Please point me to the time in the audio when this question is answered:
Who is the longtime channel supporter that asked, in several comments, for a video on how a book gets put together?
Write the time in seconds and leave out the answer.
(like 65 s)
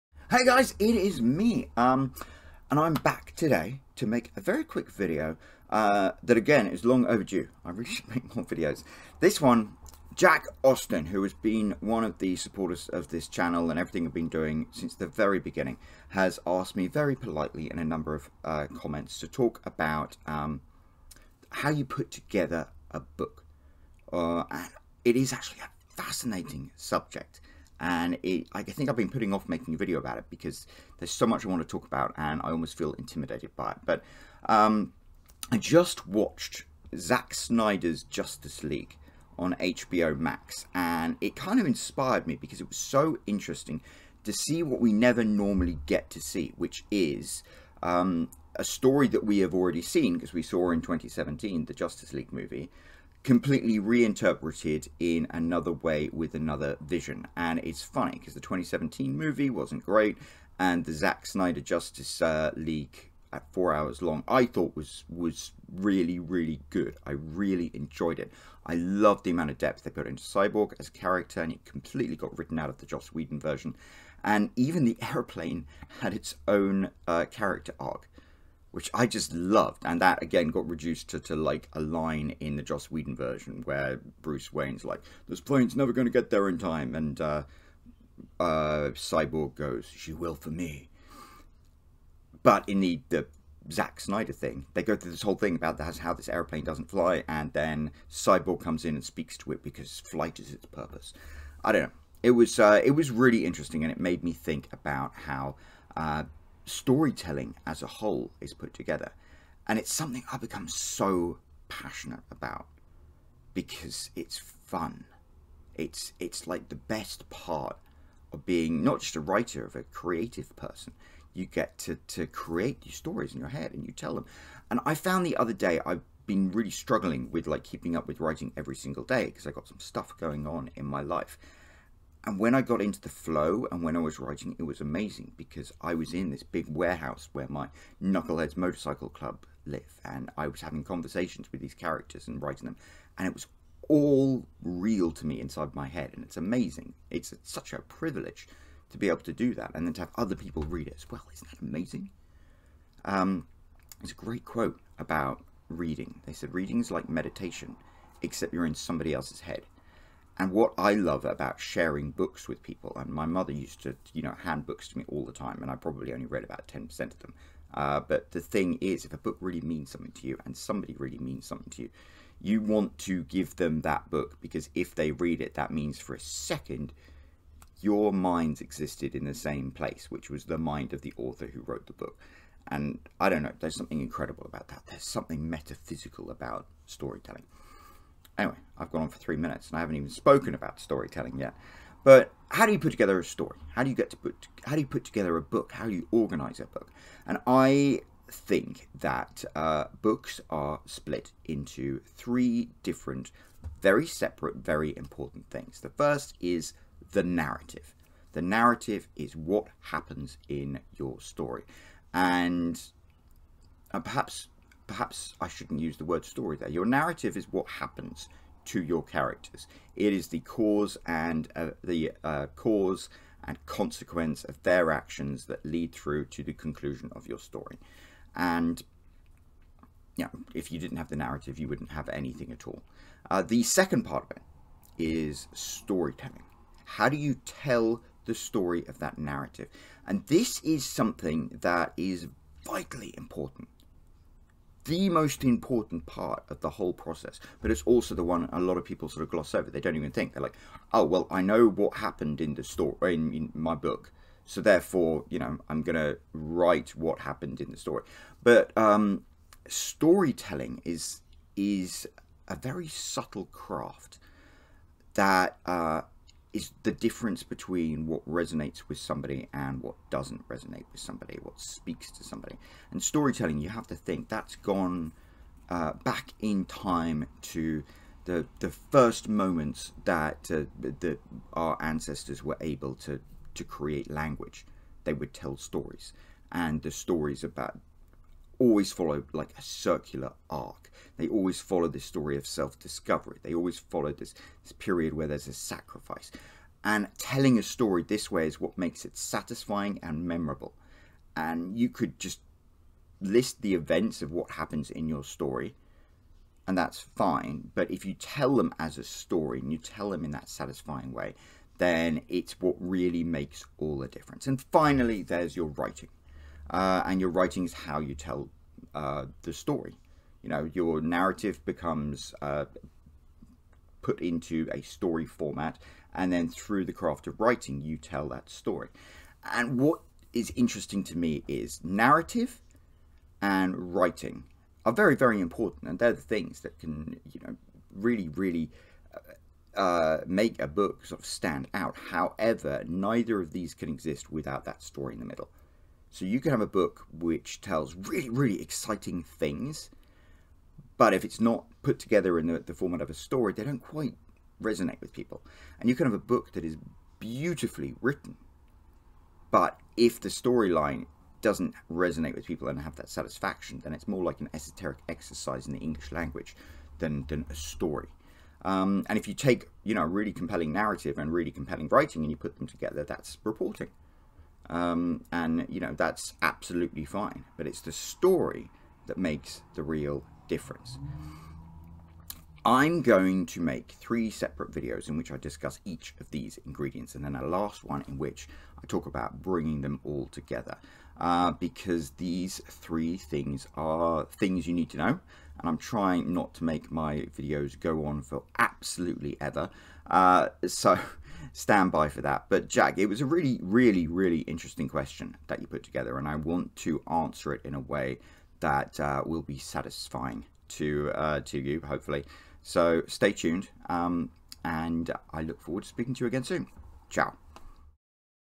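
10 s.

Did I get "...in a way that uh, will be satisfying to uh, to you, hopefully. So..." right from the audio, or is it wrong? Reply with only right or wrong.
right.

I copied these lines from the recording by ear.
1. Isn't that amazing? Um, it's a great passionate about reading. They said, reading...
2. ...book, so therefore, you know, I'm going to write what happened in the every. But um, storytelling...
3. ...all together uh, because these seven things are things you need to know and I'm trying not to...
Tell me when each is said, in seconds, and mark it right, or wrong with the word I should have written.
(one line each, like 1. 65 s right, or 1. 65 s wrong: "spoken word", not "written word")
1. 151 s wrong: "quote", not "passionate"
2. 253 s wrong: "story", not "every"
3. 390 s wrong: "three", not "seven".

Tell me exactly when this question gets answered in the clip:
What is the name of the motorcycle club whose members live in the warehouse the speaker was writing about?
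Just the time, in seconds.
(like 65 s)
138 s.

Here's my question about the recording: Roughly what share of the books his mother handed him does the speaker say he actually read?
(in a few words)
10%.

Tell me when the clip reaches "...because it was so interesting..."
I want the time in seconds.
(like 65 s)
42 s.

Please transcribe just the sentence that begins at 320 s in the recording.
You know, your narrative becomes uh, put into a story format, and then through the craft of writing, you tell that story.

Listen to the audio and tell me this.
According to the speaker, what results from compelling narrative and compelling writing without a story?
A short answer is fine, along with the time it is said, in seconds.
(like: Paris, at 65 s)
reporting, at 373 s.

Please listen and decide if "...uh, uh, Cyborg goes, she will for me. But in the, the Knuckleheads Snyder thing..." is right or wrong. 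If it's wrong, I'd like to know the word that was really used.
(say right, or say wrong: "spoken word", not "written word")
wrong: "Zack", not "Knuckleheads".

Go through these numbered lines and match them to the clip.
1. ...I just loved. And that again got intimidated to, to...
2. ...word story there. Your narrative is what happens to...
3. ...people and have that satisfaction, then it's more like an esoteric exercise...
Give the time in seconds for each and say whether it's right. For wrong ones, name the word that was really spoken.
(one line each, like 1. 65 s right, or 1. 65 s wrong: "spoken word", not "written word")
1. 78 s wrong: "reduced", not "intimidated"
2. 216 s right
3. 362 s right.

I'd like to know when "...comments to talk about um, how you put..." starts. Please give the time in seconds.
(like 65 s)
18 s.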